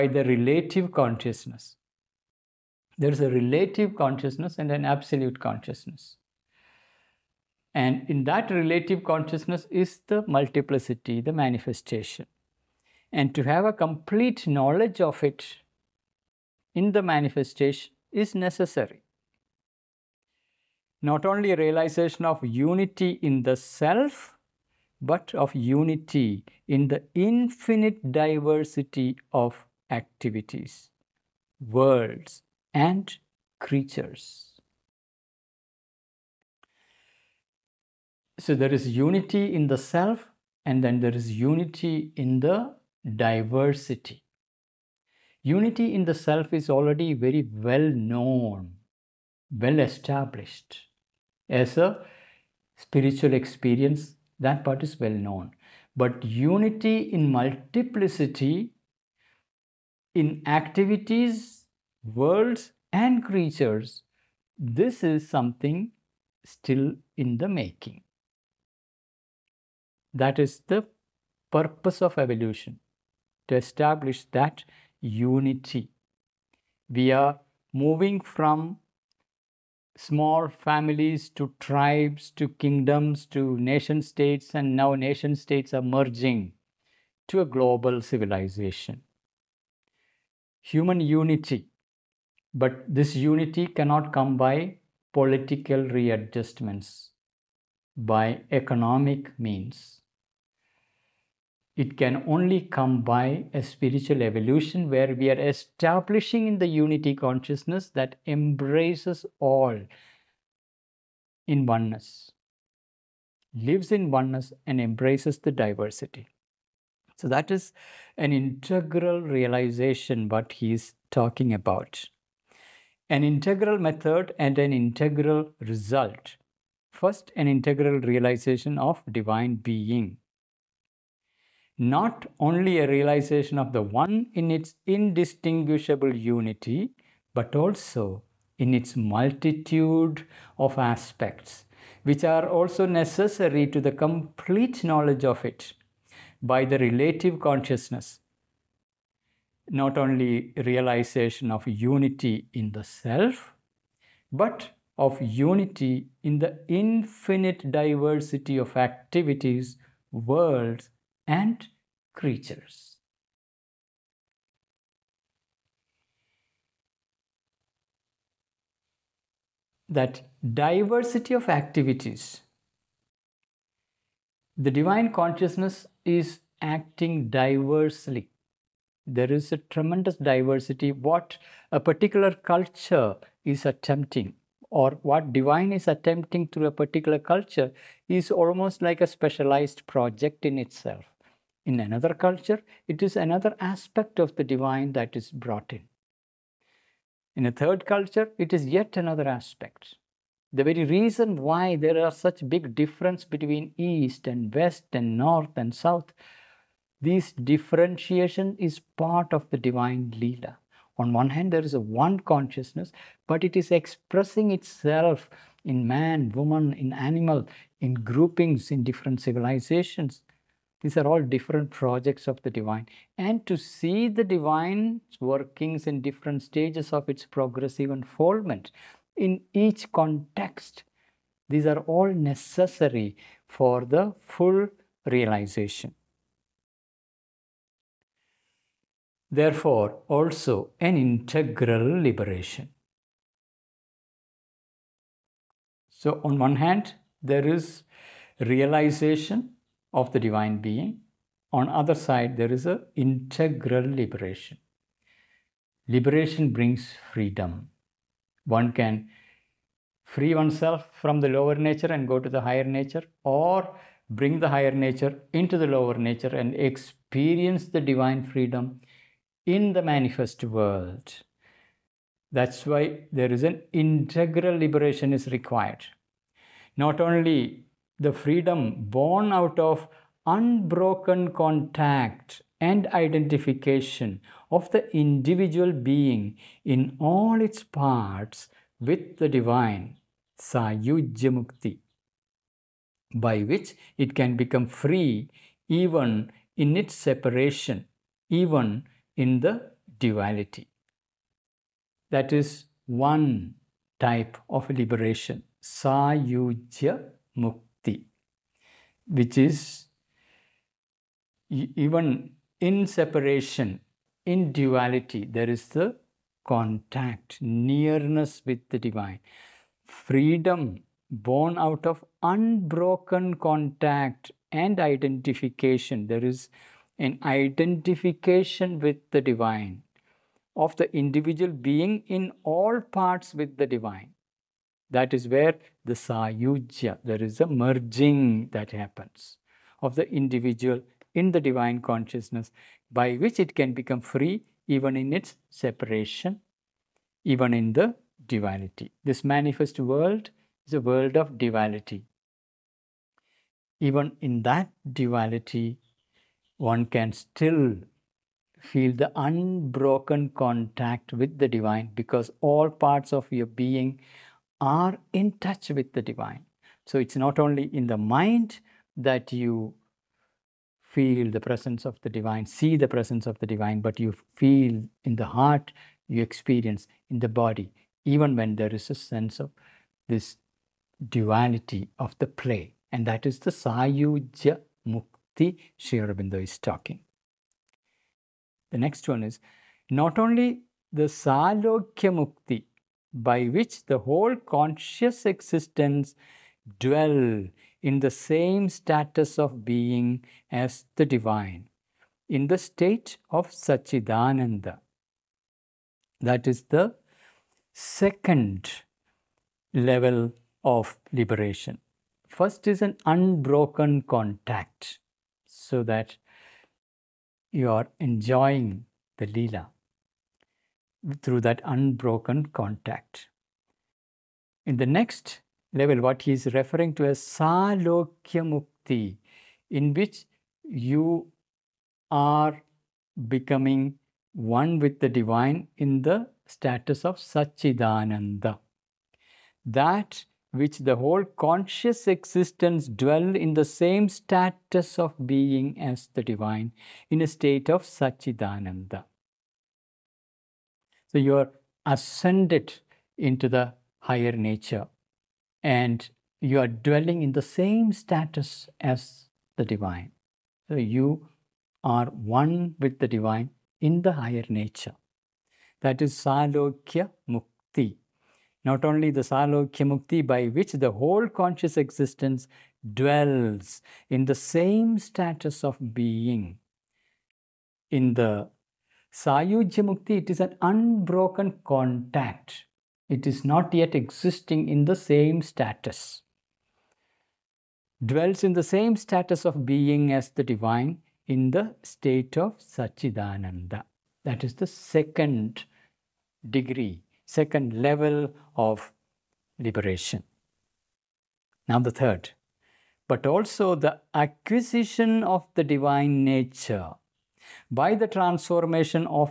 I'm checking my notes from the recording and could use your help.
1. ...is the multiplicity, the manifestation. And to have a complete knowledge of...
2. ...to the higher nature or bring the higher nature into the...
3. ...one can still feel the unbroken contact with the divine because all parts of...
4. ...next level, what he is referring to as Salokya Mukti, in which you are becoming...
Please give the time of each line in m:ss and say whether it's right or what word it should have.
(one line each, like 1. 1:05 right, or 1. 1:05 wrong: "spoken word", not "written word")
1. 0:09 right
2. 4:22 right
3. 5:56 right
4. 7:04 right.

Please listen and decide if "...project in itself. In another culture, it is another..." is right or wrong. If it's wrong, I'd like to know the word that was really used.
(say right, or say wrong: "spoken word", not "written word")
right.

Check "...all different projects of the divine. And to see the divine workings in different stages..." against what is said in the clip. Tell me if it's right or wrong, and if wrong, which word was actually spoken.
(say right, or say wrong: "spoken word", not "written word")
right.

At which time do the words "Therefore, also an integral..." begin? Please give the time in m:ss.
3:59.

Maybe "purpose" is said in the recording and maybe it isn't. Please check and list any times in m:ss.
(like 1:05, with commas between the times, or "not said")
1:11.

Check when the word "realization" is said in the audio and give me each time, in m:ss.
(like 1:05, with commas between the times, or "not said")
0:21, 1:59, 2:08, 2:12, 2:30, 3:55, 4:08.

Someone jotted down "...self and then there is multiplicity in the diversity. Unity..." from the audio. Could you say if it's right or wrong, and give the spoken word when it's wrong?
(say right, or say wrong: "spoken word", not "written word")
wrong: "unity", not "multiplicity".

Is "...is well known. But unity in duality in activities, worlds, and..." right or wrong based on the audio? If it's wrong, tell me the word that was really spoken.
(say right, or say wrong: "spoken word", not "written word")
wrong: "multiplicity", not "duality".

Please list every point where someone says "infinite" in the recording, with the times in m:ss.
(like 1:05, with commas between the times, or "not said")
0:27, 2:36.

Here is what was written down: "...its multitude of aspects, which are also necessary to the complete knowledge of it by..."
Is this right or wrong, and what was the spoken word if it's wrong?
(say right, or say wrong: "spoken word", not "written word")
right.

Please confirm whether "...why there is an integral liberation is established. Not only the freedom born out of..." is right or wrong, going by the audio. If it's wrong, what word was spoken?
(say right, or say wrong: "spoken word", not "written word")
wrong: "required", not "established".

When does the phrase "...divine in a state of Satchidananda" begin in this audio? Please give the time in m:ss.
7:26.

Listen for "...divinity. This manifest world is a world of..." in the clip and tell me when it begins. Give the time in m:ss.
5:48.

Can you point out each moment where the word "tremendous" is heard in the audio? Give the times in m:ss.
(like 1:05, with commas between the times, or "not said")
2:59.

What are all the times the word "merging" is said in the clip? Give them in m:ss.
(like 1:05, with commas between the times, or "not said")
1:25, 5:37.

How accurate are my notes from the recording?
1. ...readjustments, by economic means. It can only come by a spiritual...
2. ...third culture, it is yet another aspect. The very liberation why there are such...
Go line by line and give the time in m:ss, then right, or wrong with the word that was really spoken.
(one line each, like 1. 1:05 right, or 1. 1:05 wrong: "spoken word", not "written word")
1. 1:35 right
2. 3:17 wrong: "reason", not "liberation".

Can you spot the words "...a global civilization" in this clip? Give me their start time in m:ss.
1:27.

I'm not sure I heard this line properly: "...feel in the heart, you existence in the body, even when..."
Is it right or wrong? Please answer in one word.
wrong.